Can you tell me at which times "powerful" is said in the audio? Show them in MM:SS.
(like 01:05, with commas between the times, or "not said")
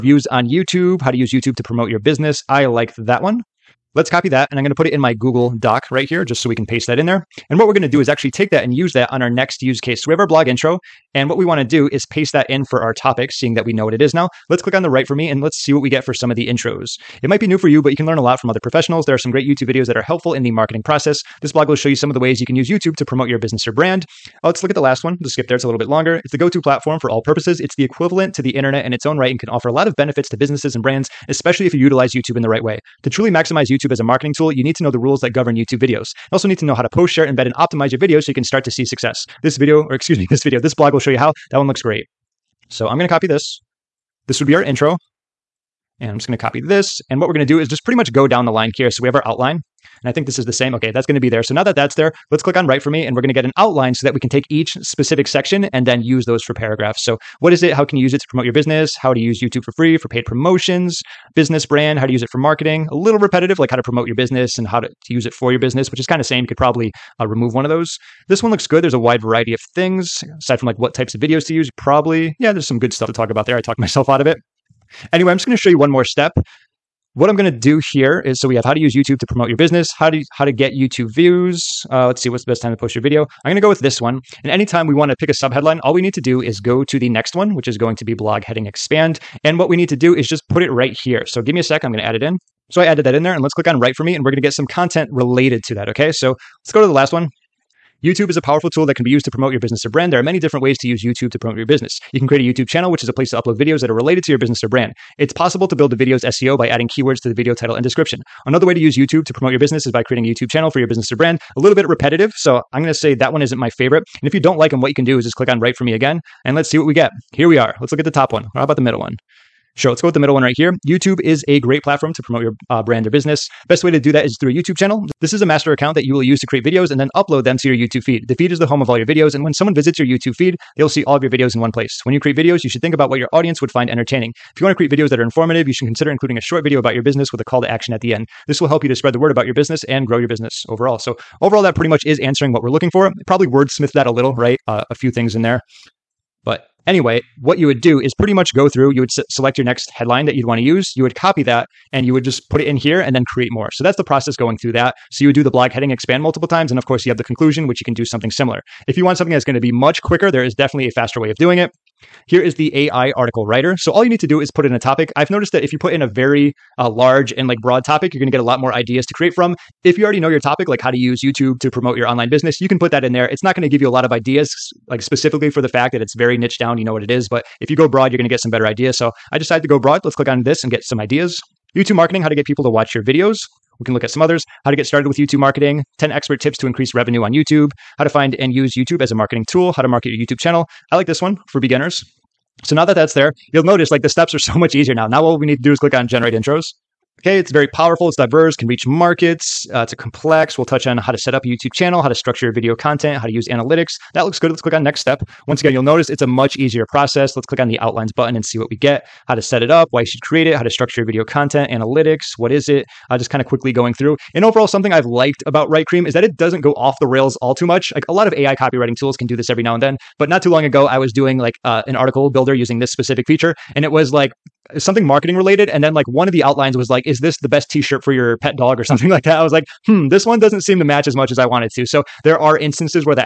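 01:38, 03:17.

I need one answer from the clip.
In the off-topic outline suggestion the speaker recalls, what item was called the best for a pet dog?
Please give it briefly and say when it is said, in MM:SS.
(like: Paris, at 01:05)
T-shirt, at 03:47.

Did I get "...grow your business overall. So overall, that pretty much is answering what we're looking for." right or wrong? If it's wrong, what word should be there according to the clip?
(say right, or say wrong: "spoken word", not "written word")
right.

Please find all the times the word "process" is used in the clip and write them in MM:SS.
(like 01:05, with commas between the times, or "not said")
00:20, 02:34, 03:26.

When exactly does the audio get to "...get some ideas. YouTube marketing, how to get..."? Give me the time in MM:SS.
03:00.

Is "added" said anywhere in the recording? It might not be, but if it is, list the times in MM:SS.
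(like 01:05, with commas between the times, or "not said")
01:32.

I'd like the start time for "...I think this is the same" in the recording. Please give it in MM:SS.
00:50.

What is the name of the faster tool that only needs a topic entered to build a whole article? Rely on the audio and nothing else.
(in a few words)
AI article writer.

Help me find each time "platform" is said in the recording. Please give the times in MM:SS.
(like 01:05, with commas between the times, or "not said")
00:26, 02:01.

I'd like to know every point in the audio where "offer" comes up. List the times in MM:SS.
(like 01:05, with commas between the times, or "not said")
00:29.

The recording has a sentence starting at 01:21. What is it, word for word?
Uh, let's see what's the best time to post your video.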